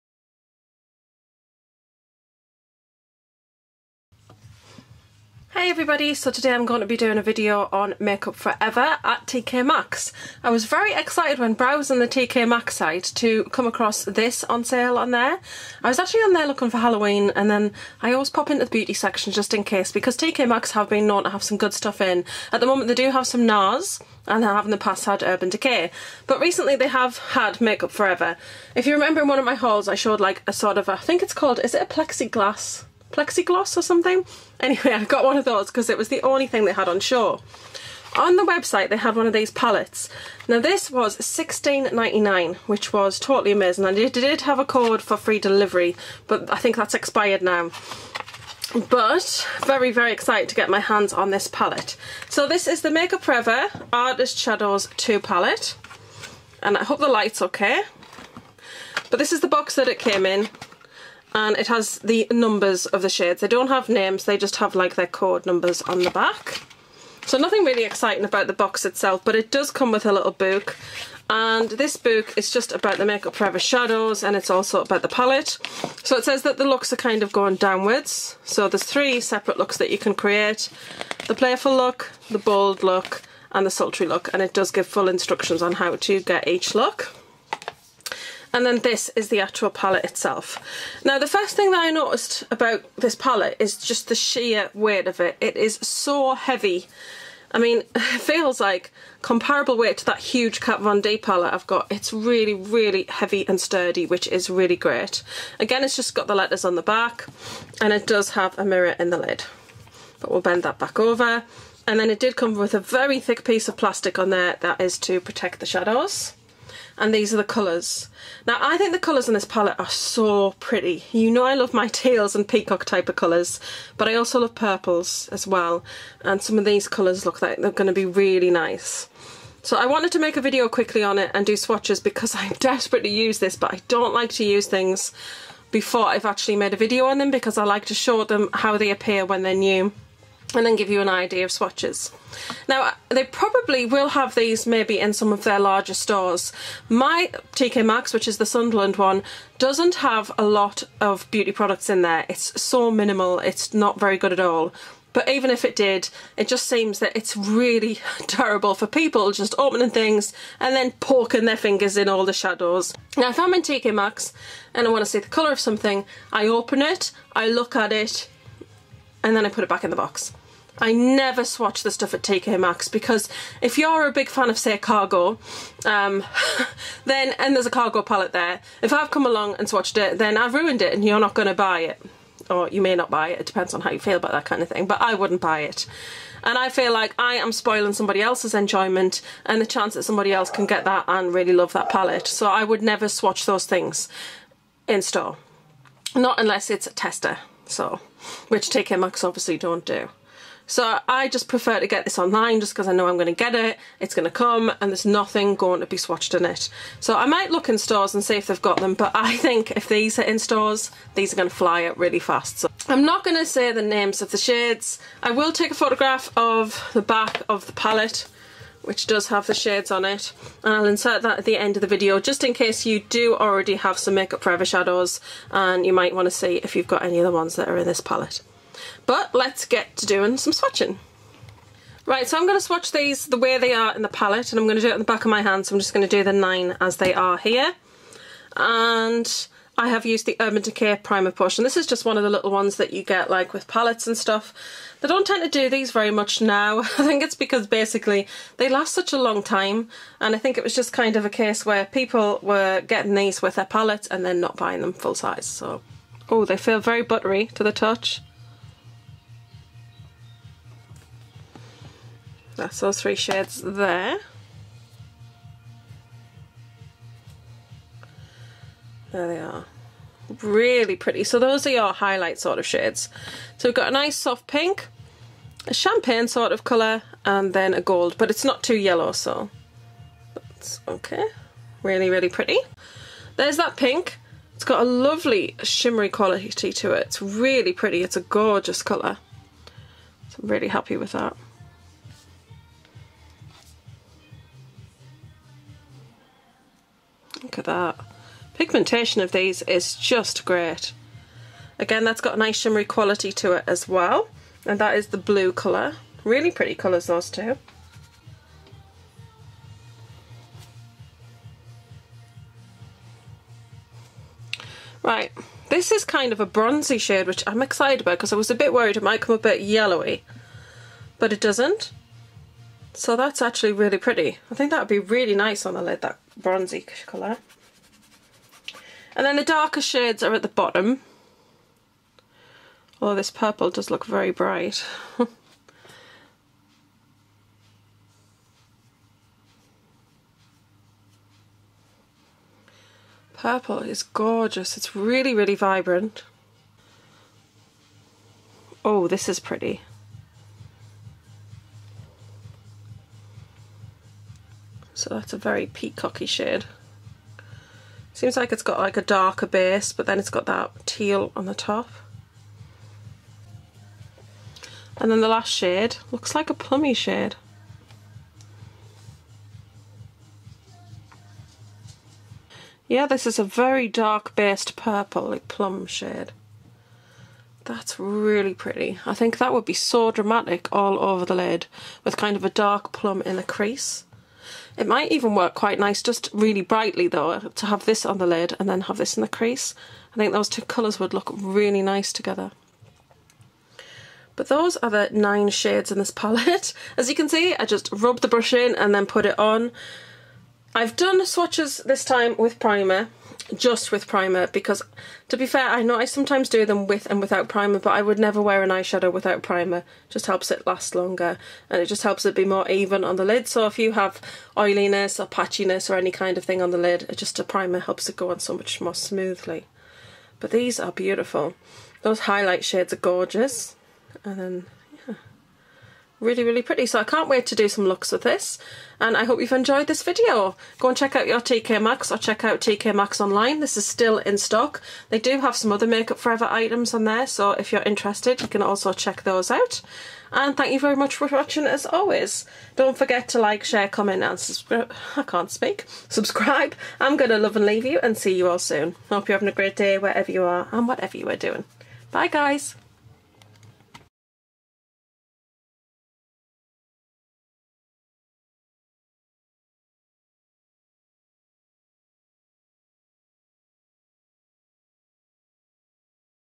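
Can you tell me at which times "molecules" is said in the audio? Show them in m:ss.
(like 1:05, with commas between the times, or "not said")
not said.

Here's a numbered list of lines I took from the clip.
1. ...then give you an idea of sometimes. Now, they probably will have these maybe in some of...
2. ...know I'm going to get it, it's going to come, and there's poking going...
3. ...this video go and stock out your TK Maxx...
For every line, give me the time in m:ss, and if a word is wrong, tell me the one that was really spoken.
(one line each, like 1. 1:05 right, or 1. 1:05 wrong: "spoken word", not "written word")
1. 2:20 wrong: "swatches", not "sometimes"
2. 3:22 wrong: "nothing", not "poking"
3. 7:09 wrong: "check", not "stock".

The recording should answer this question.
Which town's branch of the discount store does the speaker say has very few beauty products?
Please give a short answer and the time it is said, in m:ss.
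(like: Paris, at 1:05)
Sunderland, at 2:28.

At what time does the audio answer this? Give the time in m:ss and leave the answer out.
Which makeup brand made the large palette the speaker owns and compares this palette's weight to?
1:40.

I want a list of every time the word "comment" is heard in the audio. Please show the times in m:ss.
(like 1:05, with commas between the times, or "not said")
7:23.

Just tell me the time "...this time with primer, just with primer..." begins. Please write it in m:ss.
6:41.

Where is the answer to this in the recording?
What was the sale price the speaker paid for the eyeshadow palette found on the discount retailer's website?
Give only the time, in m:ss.
0:41.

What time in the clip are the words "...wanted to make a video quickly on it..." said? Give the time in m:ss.
2:09.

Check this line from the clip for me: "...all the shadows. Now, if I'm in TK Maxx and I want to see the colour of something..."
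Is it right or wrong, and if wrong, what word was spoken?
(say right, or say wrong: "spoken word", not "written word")
right.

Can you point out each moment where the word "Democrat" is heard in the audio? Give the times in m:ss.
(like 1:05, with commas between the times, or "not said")
not said.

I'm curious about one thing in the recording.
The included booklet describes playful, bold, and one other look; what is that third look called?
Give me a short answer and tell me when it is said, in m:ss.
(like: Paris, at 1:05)
sultry, at 1:23.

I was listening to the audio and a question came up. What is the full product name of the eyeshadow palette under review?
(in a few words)
Artist Shadows 2.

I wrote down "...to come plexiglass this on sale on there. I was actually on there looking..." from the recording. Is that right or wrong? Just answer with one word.
wrong.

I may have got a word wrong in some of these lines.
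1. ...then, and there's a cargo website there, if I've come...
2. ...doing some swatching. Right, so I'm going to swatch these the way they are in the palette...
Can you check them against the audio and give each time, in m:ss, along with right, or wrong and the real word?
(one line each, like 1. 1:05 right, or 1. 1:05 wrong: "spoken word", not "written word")
1. 2:57 wrong: "palette", not "website"
2. 3:50 right.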